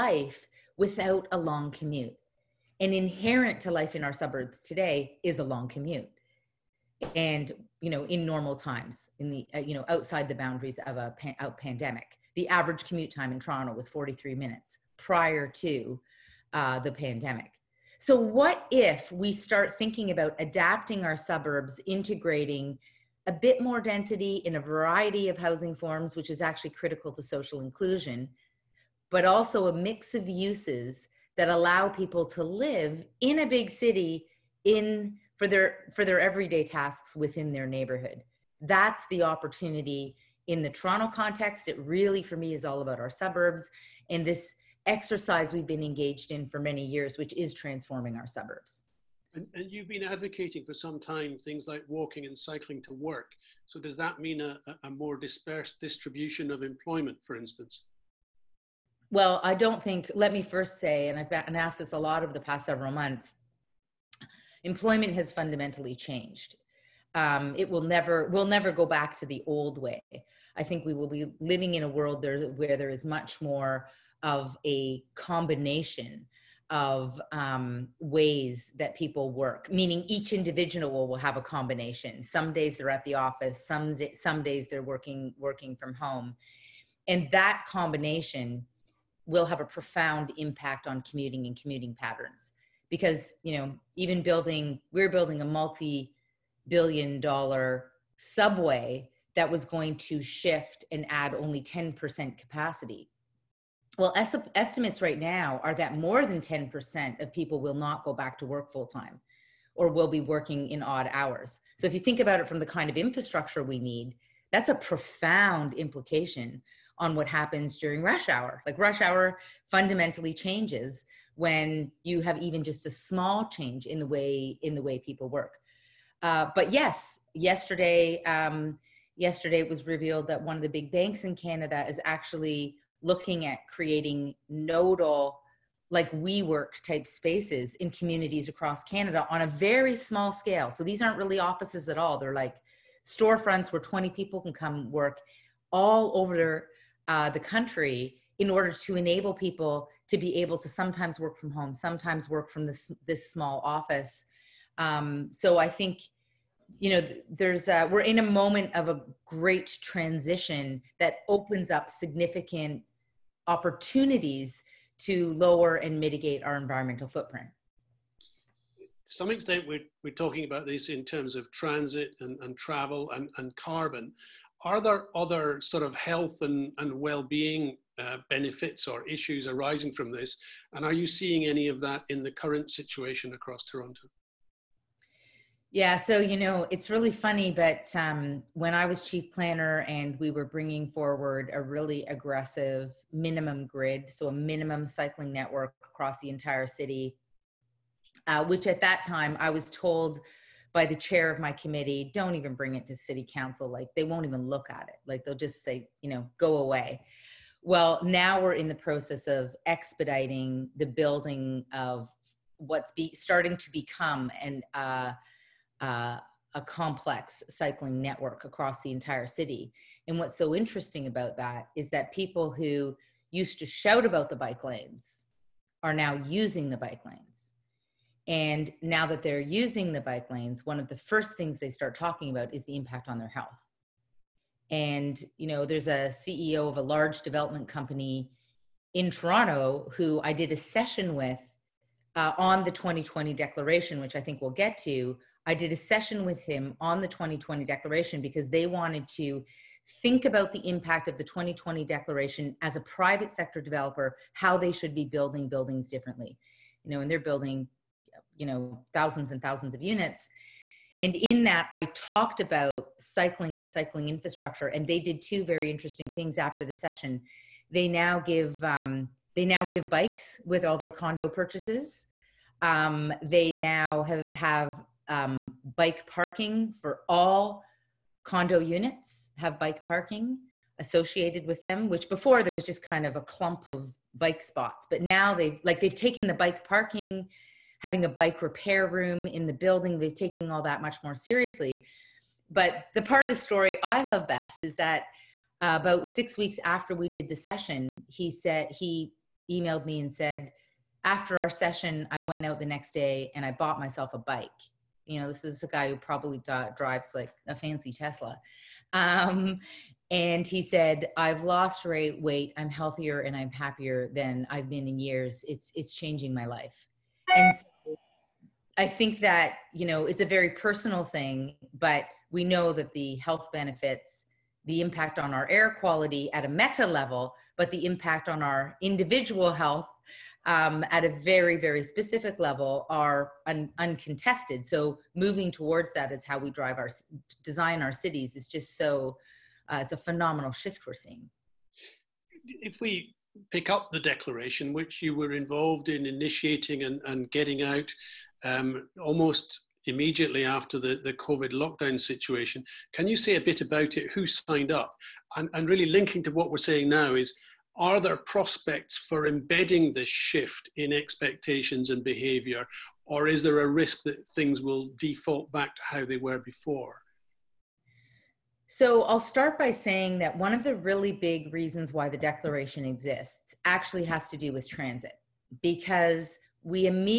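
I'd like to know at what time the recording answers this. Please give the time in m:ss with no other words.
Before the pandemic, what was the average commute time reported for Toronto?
0:13.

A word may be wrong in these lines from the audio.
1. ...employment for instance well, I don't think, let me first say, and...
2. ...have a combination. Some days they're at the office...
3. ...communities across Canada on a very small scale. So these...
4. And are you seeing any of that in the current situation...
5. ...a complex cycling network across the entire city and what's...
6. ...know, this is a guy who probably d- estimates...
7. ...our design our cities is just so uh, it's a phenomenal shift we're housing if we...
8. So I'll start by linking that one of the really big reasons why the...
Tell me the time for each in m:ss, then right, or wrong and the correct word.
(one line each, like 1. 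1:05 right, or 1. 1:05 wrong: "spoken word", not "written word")
1. 0:56 right
2. 1:21 right
3. 2:17 right
4. 3:00 right
5. 3:36 right
6. 5:05 wrong: "drives", not "estimates"
7. 5:36 wrong: "seeing", not "housing"
8. 6:08 wrong: "saying", not "linking".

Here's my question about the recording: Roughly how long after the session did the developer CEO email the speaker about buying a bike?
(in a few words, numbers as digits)
six weeks.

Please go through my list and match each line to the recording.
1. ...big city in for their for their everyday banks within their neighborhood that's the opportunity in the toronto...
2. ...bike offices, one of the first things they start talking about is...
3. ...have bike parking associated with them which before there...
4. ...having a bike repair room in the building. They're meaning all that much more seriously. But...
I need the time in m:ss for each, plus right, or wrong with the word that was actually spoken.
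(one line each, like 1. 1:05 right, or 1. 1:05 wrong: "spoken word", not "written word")
1. 0:33 wrong: "tasks", not "banks"
2. 3:50 wrong: "lanes", not "offices"
3. 4:39 right
4. 4:47 wrong: "taking", not "meaning".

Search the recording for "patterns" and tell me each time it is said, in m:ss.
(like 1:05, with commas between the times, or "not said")
1:31.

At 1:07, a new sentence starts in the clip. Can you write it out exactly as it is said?
Um, it will never, we'll never go back to the old way.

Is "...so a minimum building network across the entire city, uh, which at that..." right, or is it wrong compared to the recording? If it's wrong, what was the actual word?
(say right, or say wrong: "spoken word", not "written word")
wrong: "cycling", not "building".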